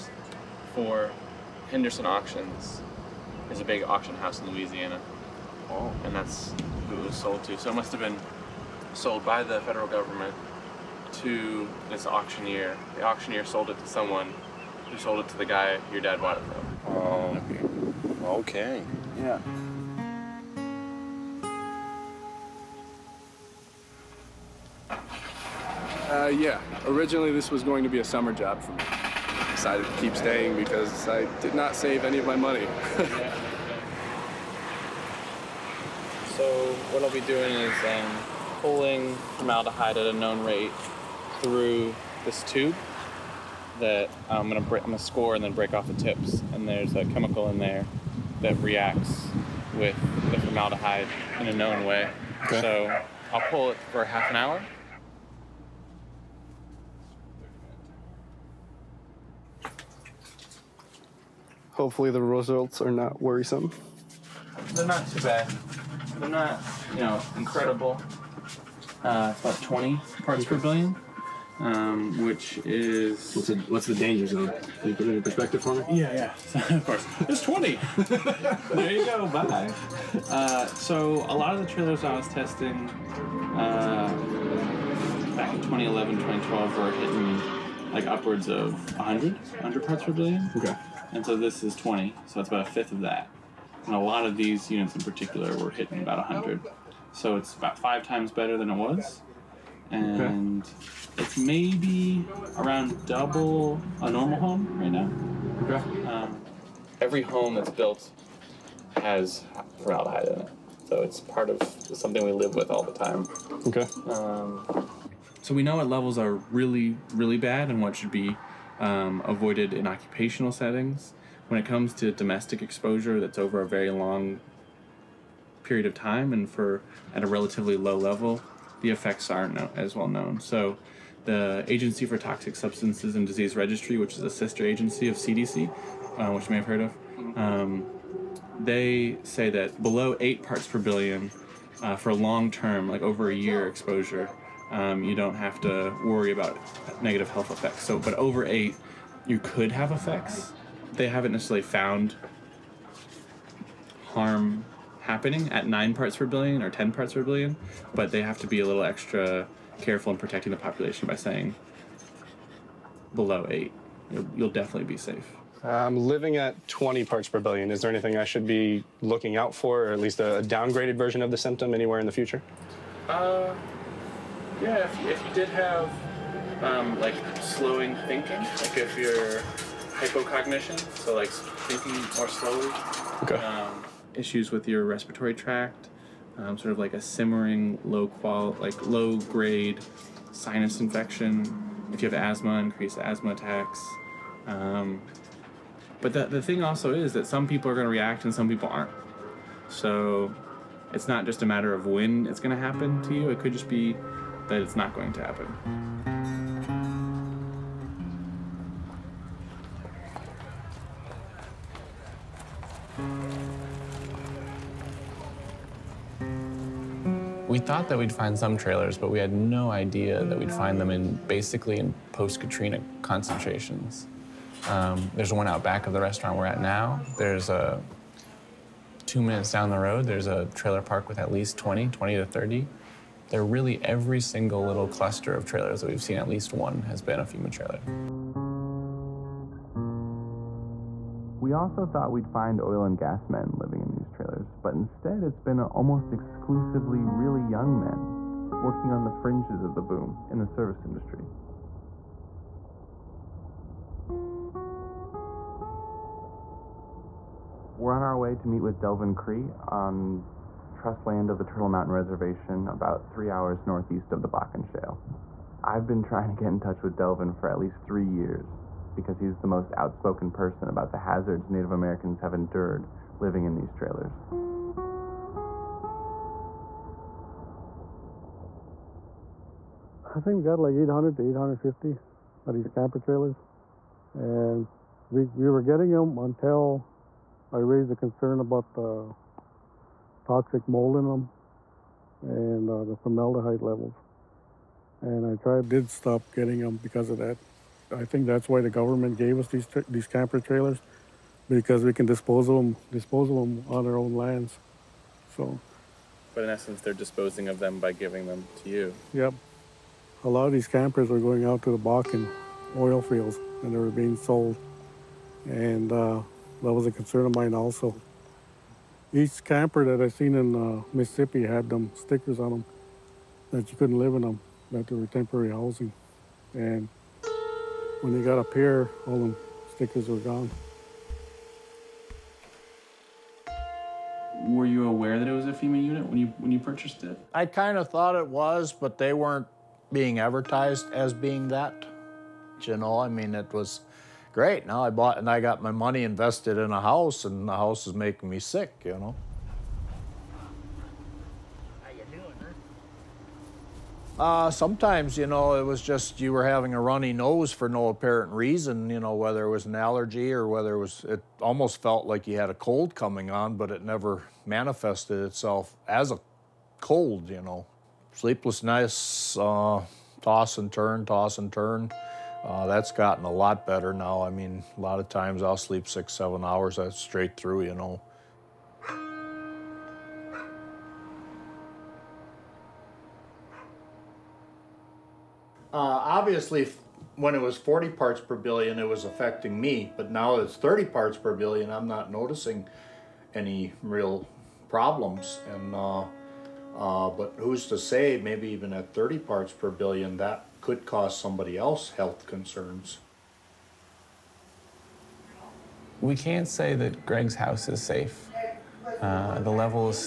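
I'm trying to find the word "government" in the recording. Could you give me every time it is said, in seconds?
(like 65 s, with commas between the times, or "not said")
9 s, 298 s.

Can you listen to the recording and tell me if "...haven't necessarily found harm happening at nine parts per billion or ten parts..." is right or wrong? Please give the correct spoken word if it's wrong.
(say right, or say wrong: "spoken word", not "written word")
right.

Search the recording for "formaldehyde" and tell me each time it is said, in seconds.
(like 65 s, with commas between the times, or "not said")
39 s, 50 s, 109 s, 292 s.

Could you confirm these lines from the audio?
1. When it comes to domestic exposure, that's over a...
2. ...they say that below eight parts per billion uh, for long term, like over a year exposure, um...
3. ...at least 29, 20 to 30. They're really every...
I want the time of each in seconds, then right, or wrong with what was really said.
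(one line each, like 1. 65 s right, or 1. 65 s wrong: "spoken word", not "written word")
1. 121 s right
2. 138 s right
3. 231 s wrong: "20", not "29".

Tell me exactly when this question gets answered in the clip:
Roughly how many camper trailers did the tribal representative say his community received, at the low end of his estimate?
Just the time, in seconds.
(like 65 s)
280 s.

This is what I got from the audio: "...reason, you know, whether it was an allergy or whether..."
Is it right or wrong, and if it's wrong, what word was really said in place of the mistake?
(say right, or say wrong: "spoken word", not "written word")
right.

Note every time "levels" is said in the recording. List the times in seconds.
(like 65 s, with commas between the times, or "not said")
115 s, 127 s, 293 s, 409 s.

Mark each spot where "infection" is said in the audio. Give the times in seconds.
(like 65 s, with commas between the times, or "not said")
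190 s.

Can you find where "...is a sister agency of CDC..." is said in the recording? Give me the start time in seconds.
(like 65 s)
134 s.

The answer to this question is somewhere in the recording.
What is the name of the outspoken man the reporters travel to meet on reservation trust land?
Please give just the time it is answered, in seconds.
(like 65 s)
258 s.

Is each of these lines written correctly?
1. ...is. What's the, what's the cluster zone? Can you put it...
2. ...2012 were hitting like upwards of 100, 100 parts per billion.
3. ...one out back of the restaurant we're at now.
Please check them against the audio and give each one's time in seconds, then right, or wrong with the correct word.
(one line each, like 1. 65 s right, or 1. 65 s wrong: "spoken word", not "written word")
1. 72 s wrong: "danger", not "cluster"
2. 86 s right
3. 225 s right.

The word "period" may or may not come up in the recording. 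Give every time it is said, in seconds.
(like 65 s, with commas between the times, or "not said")
125 s.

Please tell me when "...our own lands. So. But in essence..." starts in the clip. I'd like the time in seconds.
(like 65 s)
303 s.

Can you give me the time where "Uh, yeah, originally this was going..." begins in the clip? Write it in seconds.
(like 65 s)
26 s.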